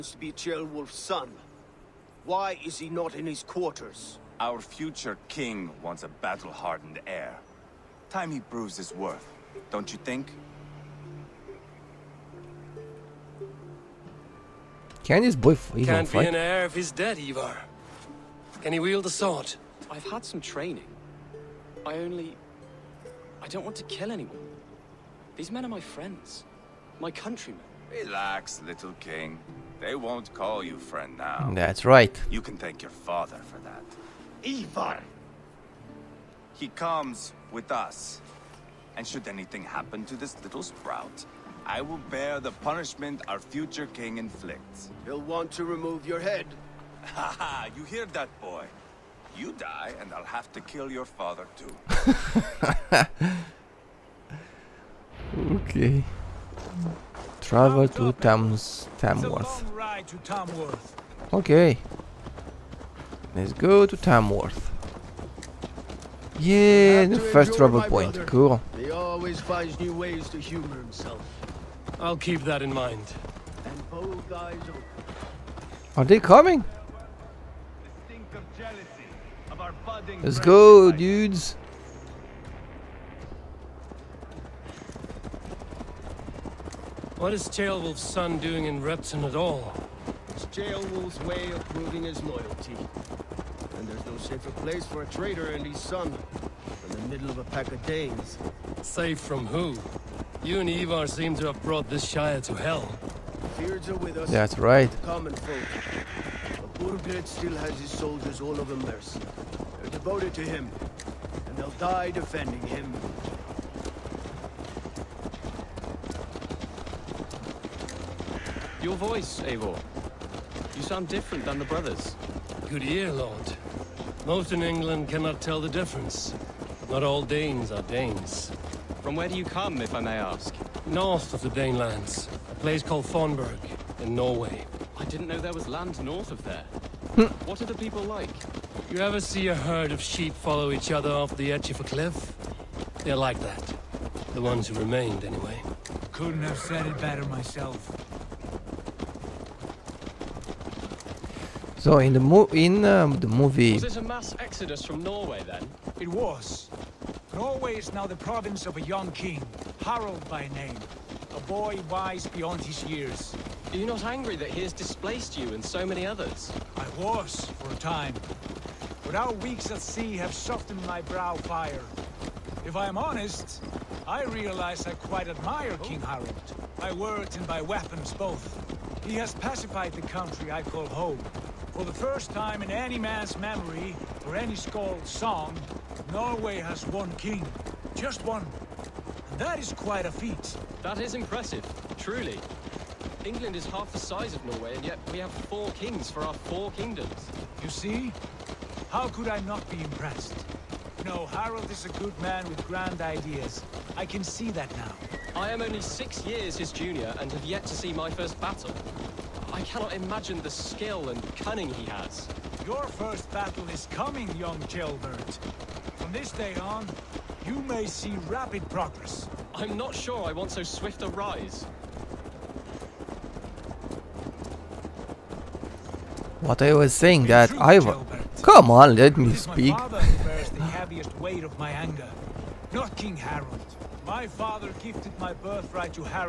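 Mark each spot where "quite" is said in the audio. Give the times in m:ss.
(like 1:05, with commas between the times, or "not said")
2:54, 3:09.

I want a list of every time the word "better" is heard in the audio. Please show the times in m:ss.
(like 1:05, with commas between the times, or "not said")
2:27.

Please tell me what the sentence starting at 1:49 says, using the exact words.
They're devoted to him, and they'll die defending him.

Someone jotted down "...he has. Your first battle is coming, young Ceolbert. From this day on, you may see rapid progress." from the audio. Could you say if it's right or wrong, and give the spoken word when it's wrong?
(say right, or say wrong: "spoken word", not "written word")
right.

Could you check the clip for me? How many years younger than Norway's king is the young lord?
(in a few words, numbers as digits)
6.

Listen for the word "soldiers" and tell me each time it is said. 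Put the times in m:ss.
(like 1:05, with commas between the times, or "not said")
1:47.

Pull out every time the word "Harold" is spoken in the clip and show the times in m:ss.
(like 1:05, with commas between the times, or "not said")
3:21, 3:53.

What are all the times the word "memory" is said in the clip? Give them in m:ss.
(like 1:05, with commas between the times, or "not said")
3:03.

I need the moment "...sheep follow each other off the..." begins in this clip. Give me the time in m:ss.
2:20.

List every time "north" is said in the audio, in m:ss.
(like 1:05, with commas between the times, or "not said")
2:10, 2:16.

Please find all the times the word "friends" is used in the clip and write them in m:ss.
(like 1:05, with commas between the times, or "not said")
0:25, 0:30.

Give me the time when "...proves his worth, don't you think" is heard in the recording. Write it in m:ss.
0:08.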